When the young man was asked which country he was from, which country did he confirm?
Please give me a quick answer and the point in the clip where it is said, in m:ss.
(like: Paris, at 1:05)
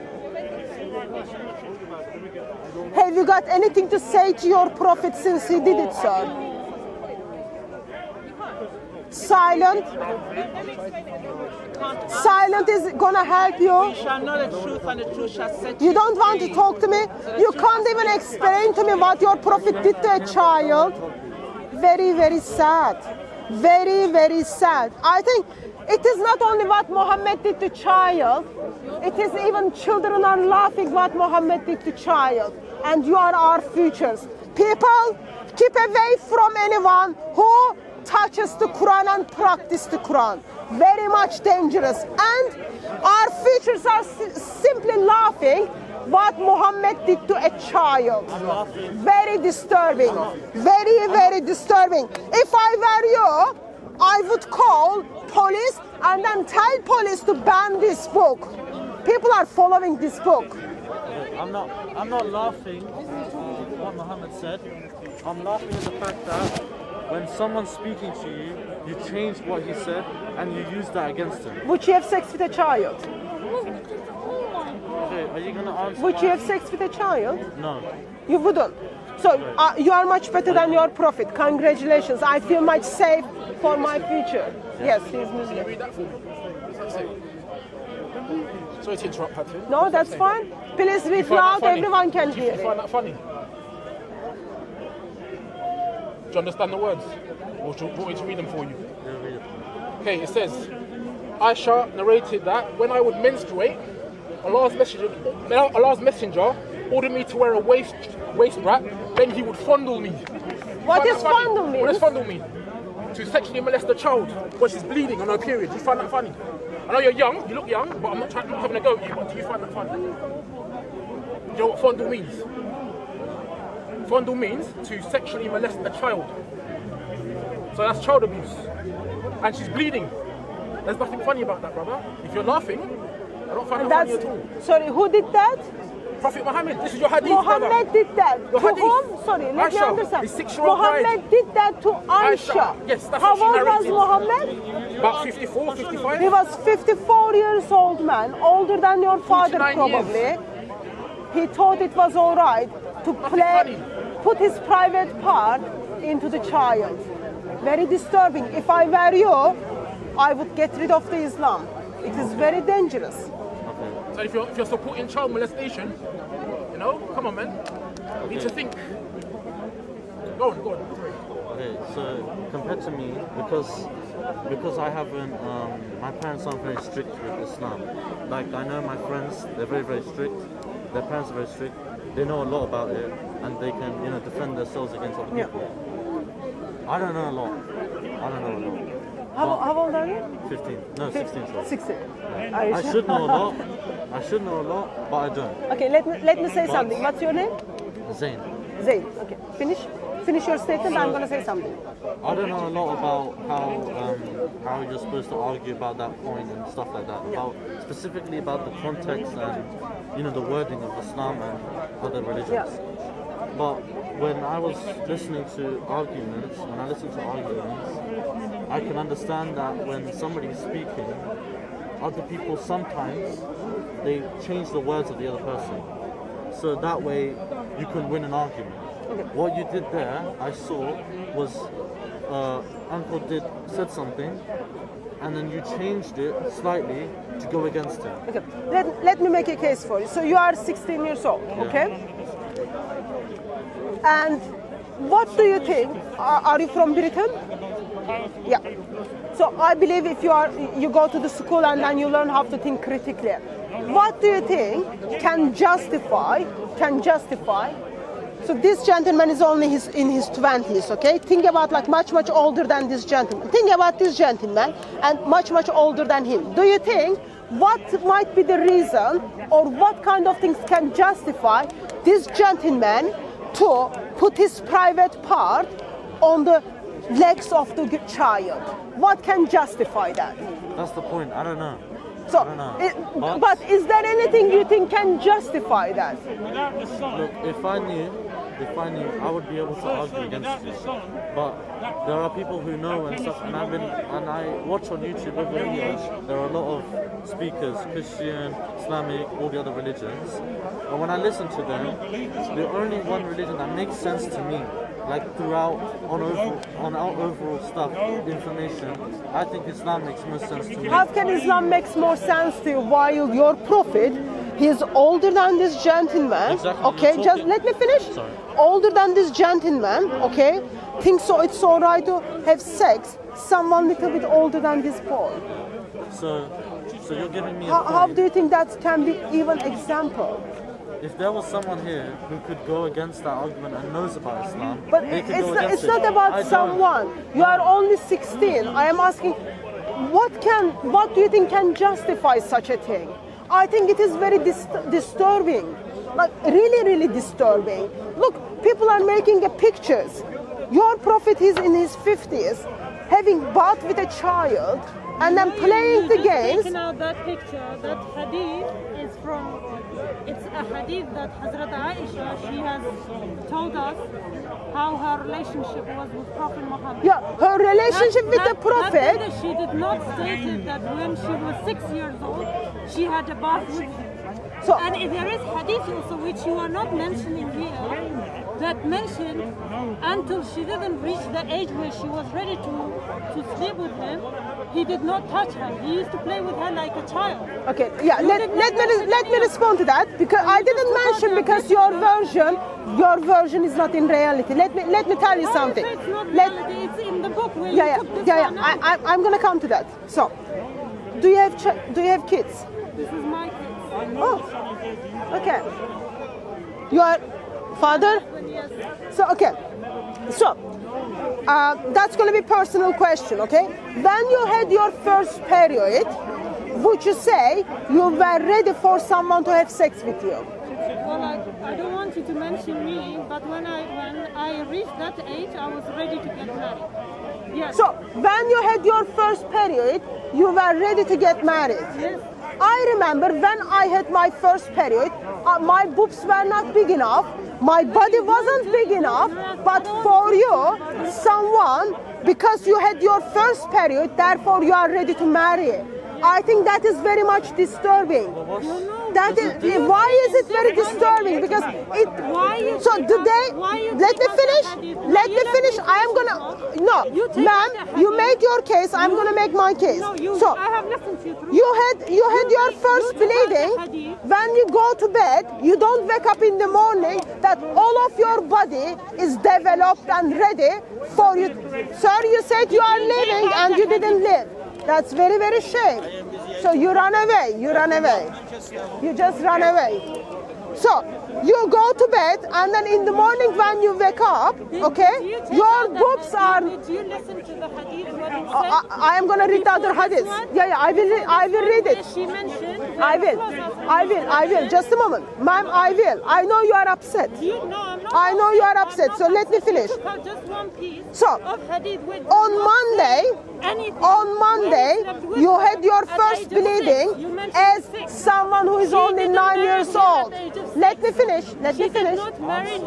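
Britain, at 4:06.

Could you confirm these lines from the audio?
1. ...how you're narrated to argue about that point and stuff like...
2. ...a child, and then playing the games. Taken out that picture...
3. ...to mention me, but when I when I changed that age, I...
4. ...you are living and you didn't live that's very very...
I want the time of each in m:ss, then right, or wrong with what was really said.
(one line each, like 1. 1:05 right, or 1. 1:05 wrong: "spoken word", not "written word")
1. 3:24 wrong: "supposed", not "narrated"
2. 5:53 right
3. 7:02 wrong: "reached", not "changed"
4. 7:52 right.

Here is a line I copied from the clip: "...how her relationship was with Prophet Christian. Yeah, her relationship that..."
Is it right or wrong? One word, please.
wrong.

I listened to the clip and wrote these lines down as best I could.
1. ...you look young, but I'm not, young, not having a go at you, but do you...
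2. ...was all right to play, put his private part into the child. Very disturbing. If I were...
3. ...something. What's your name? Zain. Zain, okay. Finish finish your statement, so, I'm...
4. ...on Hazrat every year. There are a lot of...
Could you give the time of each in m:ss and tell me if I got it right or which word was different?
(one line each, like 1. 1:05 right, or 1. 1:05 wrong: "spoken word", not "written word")
1. 1:57 wrong: "trying", not "young"
2. 2:31 right
3. 3:16 right
4. 4:54 wrong: "YouTube", not "Hazrat".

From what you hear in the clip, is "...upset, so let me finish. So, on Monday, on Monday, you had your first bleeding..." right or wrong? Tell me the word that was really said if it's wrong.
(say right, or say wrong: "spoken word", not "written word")
right.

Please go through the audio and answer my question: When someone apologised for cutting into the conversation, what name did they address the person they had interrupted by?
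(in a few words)
Patrick.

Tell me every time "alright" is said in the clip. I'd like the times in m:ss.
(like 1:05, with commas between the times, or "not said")
5:21.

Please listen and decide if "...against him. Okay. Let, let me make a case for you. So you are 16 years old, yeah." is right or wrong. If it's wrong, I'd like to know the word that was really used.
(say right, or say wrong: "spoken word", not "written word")
right.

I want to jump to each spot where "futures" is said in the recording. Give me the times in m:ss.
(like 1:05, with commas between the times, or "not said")
0:33, 0:43, 1:23.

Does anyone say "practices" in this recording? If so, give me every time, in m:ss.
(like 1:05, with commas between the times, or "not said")
0:39.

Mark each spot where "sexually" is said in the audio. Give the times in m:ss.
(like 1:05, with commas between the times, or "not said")
1:53, 2:05.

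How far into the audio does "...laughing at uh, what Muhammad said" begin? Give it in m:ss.
1:02.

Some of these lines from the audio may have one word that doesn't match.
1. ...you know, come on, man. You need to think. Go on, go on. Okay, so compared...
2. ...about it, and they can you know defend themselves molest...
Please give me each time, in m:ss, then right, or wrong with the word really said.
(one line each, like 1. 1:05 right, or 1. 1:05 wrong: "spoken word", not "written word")
1. 2:46 right
2. 3:02 wrong: "against", not "molest".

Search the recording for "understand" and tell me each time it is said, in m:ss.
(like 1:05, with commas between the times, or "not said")
1:36, 2:19, 3:38.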